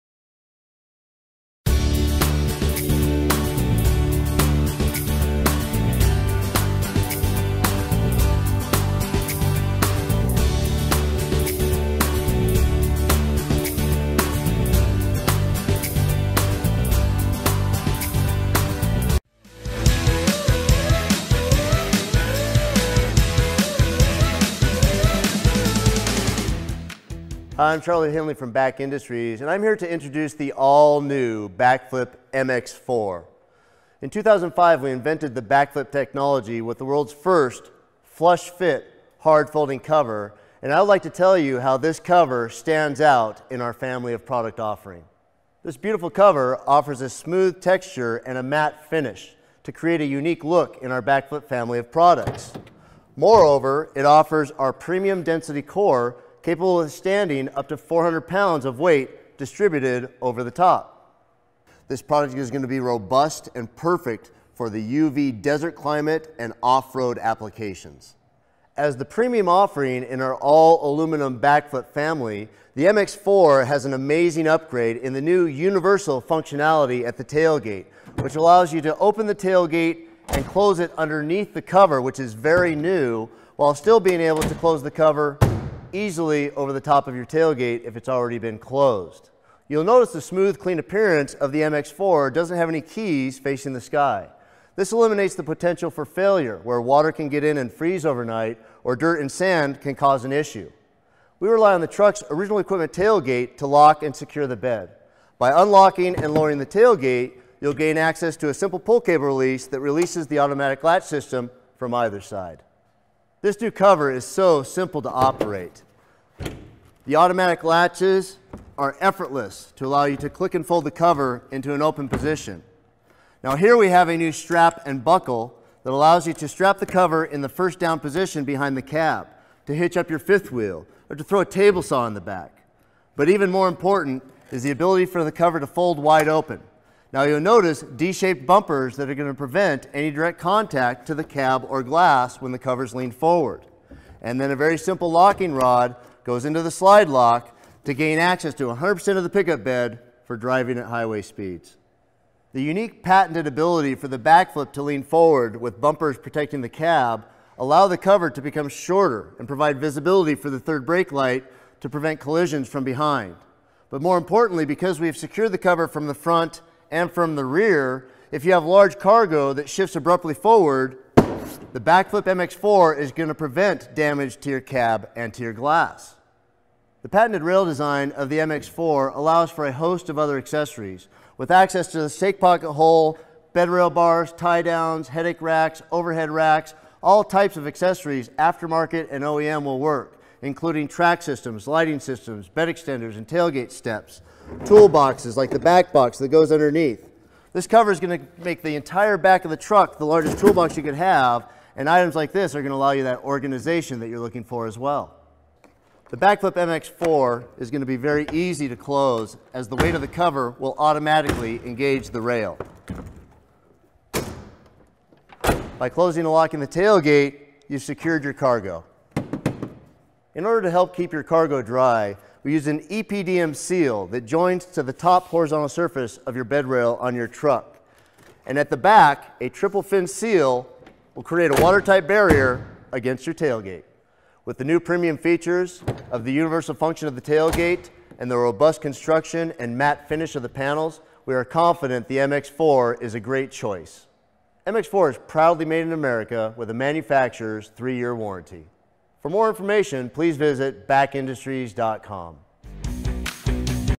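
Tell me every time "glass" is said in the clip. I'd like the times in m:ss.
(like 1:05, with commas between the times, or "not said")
2:21, 2:55.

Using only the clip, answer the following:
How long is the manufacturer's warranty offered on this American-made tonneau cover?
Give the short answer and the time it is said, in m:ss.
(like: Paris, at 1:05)
3 years, at 4:07.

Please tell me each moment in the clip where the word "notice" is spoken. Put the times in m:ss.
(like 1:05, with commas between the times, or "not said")
1:29, 2:17.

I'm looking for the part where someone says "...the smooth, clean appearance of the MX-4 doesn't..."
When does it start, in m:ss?
1:30.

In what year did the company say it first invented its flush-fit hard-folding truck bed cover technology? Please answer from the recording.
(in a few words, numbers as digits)
2005.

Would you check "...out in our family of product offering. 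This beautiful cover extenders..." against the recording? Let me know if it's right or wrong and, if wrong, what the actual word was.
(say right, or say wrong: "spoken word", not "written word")
wrong: "offers", not "extenders".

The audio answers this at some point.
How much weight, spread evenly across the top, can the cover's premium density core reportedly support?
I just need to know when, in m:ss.
0:57.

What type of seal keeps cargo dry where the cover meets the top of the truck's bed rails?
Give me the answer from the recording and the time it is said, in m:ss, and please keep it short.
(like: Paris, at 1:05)
EPDM seal, at 3:42.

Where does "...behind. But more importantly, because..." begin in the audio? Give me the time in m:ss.
2:42.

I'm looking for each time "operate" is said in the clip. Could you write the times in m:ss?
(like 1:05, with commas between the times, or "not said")
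1:55.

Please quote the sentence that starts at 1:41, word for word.
We rely on the truck's original equipment tailgate to lock and secure the bed.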